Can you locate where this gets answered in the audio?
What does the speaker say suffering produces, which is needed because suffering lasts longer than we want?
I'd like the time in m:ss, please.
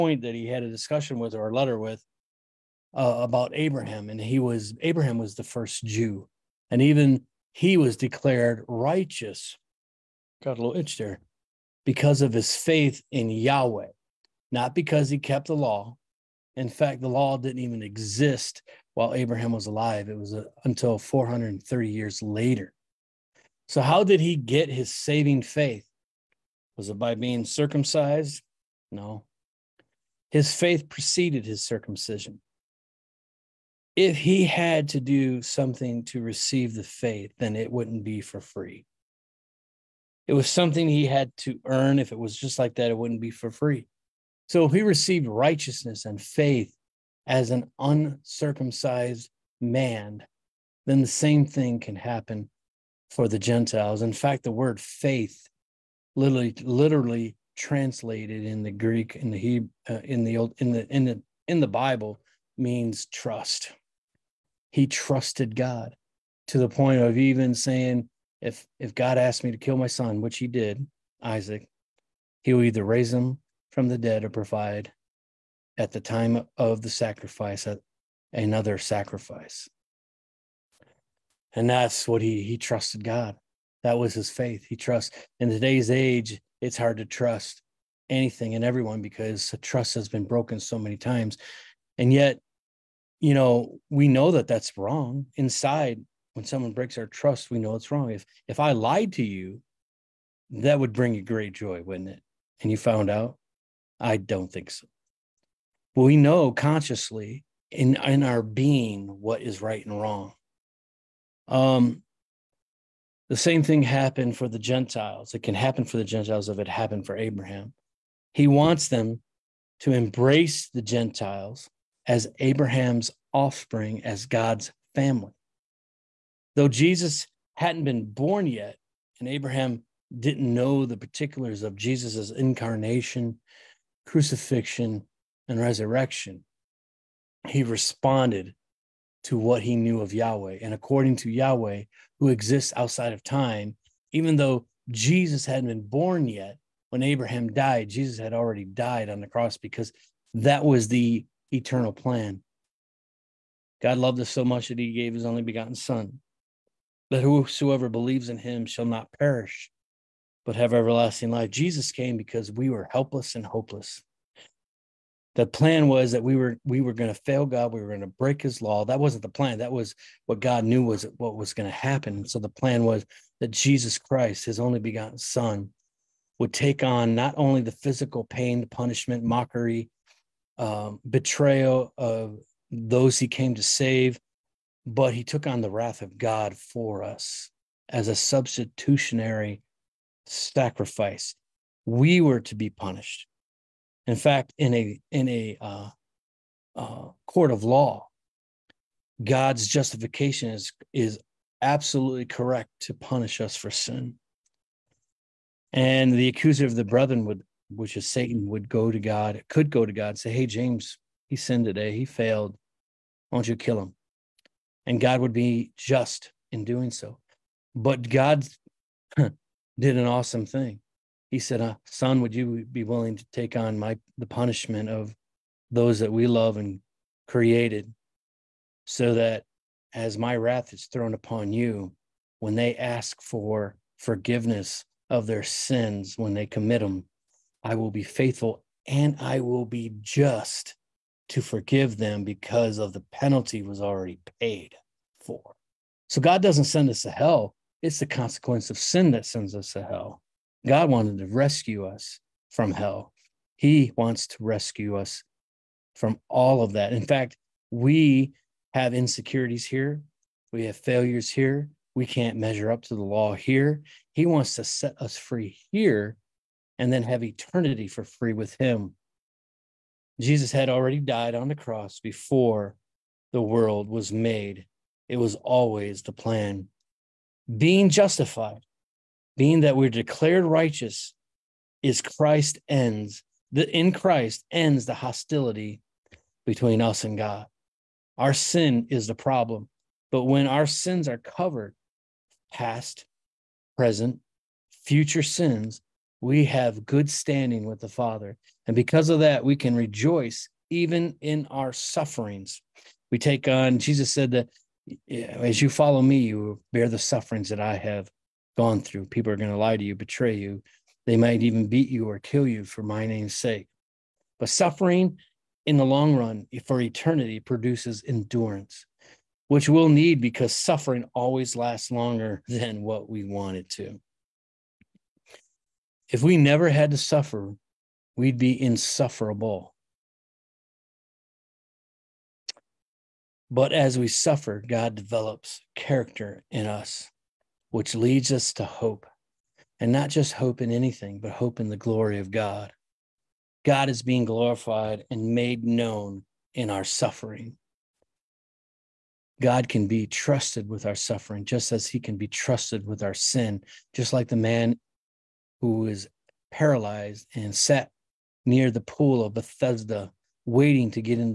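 5:18.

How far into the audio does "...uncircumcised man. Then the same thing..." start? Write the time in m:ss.
0:47.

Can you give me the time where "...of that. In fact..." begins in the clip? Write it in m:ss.
4:16.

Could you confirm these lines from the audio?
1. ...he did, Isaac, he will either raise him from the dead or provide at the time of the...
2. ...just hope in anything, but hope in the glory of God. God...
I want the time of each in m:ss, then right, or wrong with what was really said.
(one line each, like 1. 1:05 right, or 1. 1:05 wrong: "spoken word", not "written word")
1. 1:10 right
2. 5:40 right.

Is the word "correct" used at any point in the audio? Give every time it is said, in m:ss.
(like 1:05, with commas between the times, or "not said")
3:22.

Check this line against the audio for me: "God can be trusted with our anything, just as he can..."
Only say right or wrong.
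wrong.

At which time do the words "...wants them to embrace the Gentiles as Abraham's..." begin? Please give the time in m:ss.
1:58.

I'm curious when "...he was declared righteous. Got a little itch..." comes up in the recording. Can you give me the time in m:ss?
0:07.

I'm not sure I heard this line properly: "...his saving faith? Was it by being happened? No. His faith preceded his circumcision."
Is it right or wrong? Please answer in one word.
wrong.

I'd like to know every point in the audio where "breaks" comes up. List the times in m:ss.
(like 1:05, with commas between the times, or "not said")
1:36, 2:48.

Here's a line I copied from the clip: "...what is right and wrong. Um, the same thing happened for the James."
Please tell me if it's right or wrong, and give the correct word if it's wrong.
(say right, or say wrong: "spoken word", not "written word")
wrong: "Gentiles", not "James".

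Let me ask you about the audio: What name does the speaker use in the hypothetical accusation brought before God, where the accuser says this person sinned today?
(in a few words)
James.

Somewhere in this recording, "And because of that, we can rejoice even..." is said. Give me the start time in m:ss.
4:58.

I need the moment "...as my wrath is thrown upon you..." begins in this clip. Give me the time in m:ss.
3:49.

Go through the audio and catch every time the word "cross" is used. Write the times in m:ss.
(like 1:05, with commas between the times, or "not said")
2:29, 4:31.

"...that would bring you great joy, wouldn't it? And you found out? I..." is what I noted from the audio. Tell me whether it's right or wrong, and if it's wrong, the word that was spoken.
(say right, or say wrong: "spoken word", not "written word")
right.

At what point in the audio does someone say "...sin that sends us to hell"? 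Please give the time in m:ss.
4:08.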